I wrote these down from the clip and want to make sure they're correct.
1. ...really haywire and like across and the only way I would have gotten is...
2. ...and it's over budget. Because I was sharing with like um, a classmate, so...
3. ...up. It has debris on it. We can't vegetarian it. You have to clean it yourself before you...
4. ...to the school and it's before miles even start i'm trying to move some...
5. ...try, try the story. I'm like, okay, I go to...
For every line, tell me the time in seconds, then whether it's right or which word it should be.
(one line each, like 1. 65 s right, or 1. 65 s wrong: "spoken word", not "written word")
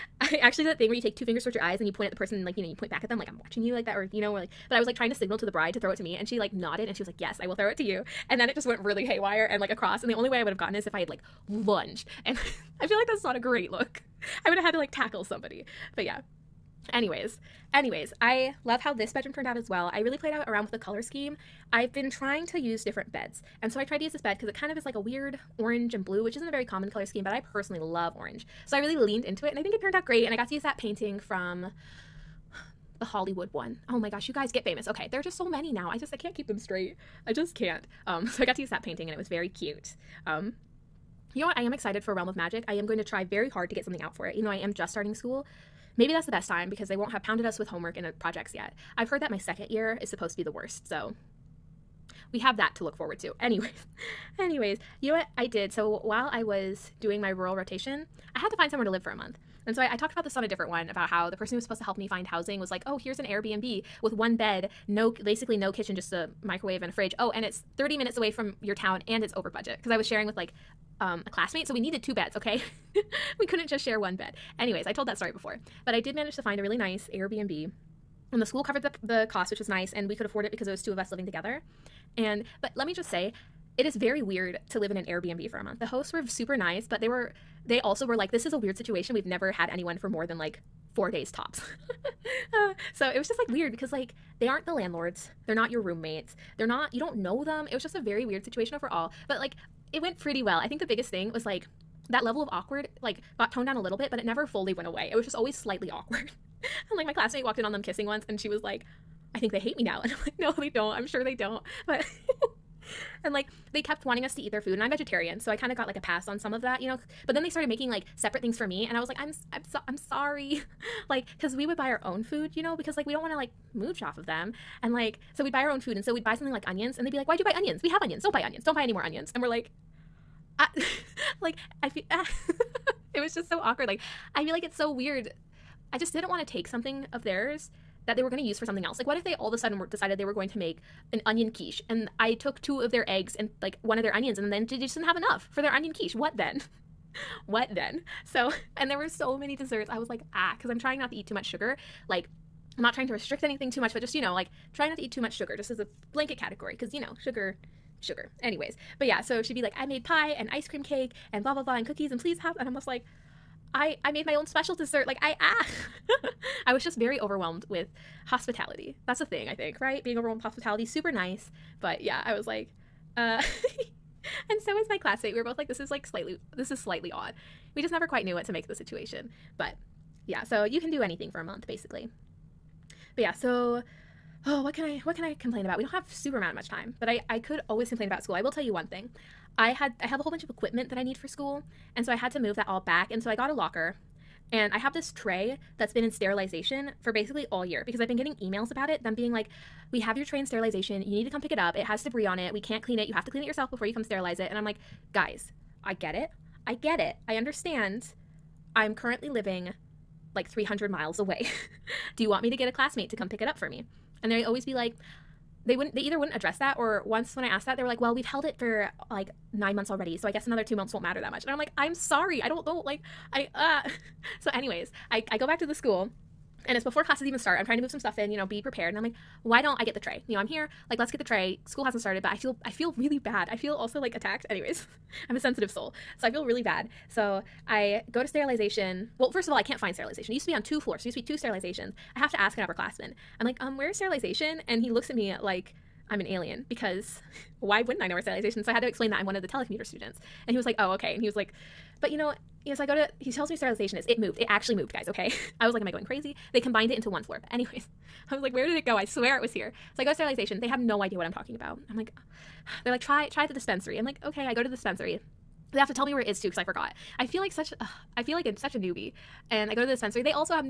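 1. 8 s right
2. 69 s right
3. 201 s wrong: "clean", not "vegetarian"
4. 225 s wrong: "classes", not "miles"
5. 263 s wrong: "dispensary", not "story".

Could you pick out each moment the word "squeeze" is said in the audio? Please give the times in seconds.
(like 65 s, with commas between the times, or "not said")
not said.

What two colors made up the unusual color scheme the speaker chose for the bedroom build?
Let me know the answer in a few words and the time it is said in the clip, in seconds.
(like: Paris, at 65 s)
orange and blue, at 25 s.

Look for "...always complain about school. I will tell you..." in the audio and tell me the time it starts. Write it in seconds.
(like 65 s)
187 s.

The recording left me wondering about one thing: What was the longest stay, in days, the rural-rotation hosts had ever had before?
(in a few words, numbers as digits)
4 days.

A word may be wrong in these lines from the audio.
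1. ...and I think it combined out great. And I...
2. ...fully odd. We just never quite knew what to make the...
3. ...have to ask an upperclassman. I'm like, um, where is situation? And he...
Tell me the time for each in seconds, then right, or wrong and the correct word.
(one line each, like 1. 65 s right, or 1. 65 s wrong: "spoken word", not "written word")
1. 29 s wrong: "turned", not "combined"
2. 176 s wrong: "slightly", not "fully"
3. 242 s wrong: "sterilization", not "situation".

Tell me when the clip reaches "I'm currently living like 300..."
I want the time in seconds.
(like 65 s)
208 s.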